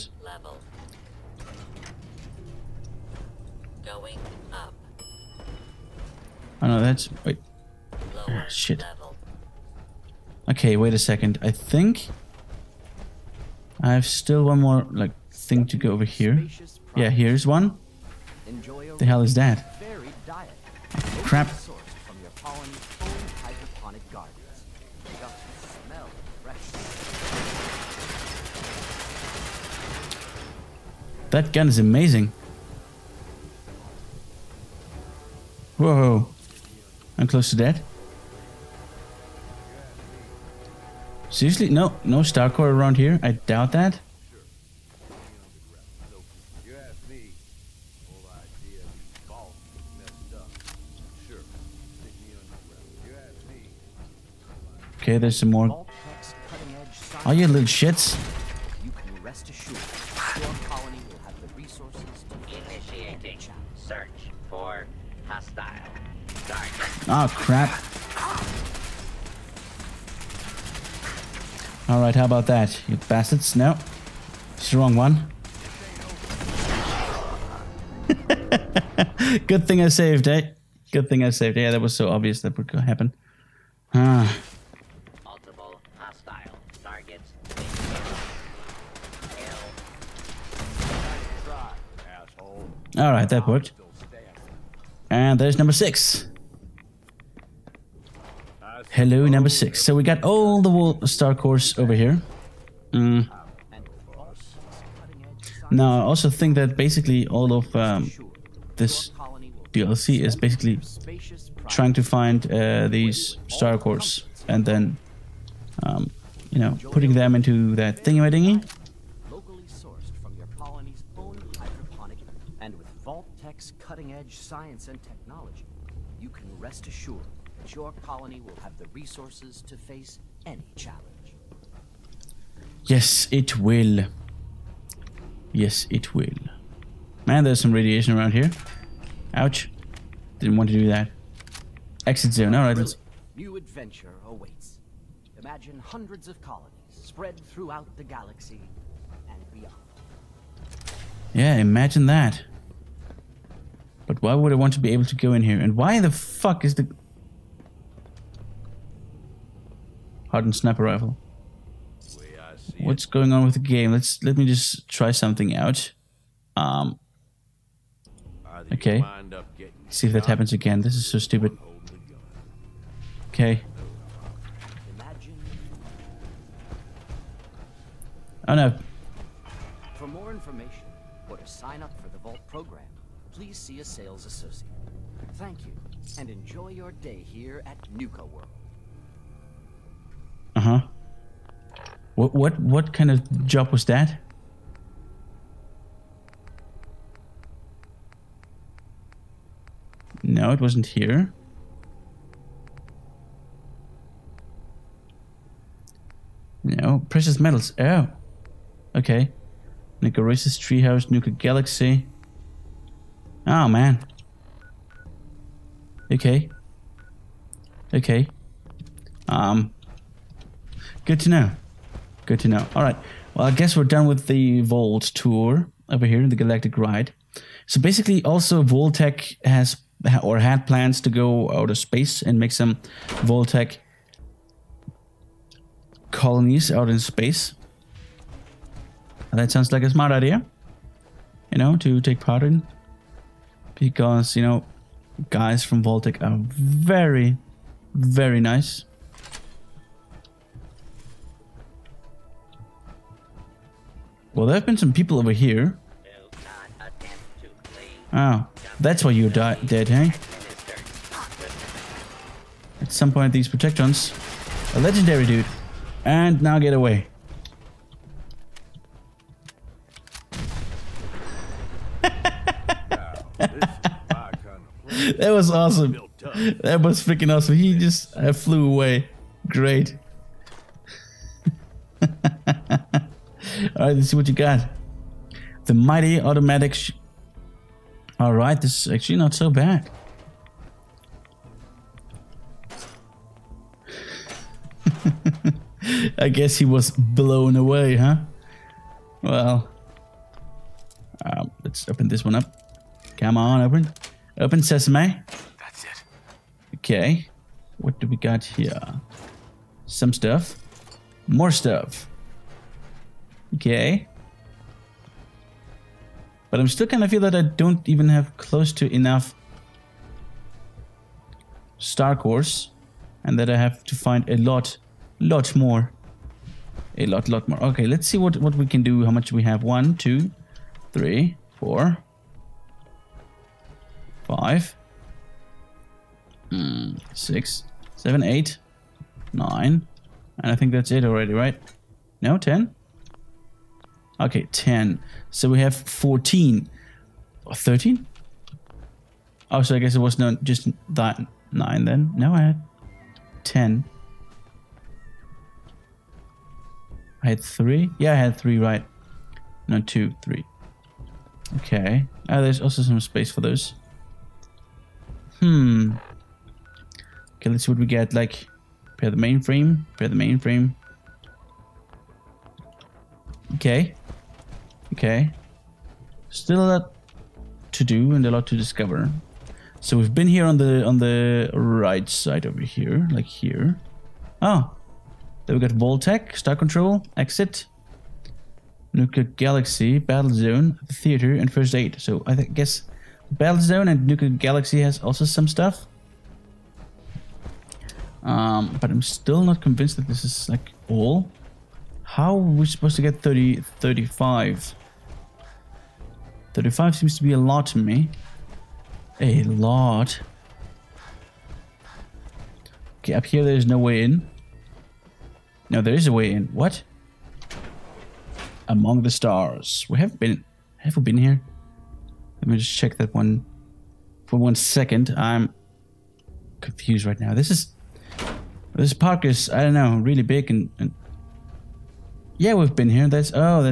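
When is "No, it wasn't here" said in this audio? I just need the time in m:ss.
3:20.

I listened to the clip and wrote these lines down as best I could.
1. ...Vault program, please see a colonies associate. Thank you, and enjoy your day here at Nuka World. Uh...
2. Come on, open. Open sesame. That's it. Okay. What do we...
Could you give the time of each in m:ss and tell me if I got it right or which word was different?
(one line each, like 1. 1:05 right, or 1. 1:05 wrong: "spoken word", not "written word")
1. 3:02 wrong: "sales", not "colonies"
2. 5:03 right.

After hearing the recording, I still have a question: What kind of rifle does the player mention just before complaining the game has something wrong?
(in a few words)
hardened sniper rifle.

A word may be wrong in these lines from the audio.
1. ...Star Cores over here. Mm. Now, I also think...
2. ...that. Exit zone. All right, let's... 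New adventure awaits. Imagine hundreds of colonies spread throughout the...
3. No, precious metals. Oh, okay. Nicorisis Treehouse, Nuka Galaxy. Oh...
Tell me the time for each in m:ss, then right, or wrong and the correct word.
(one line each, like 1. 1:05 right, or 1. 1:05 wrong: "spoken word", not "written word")
1. 1:41 right
2. 2:20 right
3. 3:26 right.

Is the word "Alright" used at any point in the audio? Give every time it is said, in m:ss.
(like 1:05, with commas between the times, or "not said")
1:11, 1:32.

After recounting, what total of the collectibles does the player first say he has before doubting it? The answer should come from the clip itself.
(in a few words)
14.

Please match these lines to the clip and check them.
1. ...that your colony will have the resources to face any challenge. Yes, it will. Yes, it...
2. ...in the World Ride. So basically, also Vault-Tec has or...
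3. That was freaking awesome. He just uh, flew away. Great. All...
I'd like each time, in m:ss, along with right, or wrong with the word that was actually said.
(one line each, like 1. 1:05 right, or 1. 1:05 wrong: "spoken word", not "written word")
1. 2:07 right
2. 3:46 wrong: "Galactic", not "World"
3. 4:36 right.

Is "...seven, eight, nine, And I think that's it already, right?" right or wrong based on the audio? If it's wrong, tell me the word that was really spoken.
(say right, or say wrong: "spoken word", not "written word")
right.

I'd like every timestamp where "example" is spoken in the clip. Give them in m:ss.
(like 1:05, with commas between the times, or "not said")
not said.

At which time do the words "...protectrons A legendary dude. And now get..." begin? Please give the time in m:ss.
4:23.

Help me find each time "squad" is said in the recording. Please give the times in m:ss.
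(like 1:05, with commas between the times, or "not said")
not said.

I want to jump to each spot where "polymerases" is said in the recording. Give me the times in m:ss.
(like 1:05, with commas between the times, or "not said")
not said.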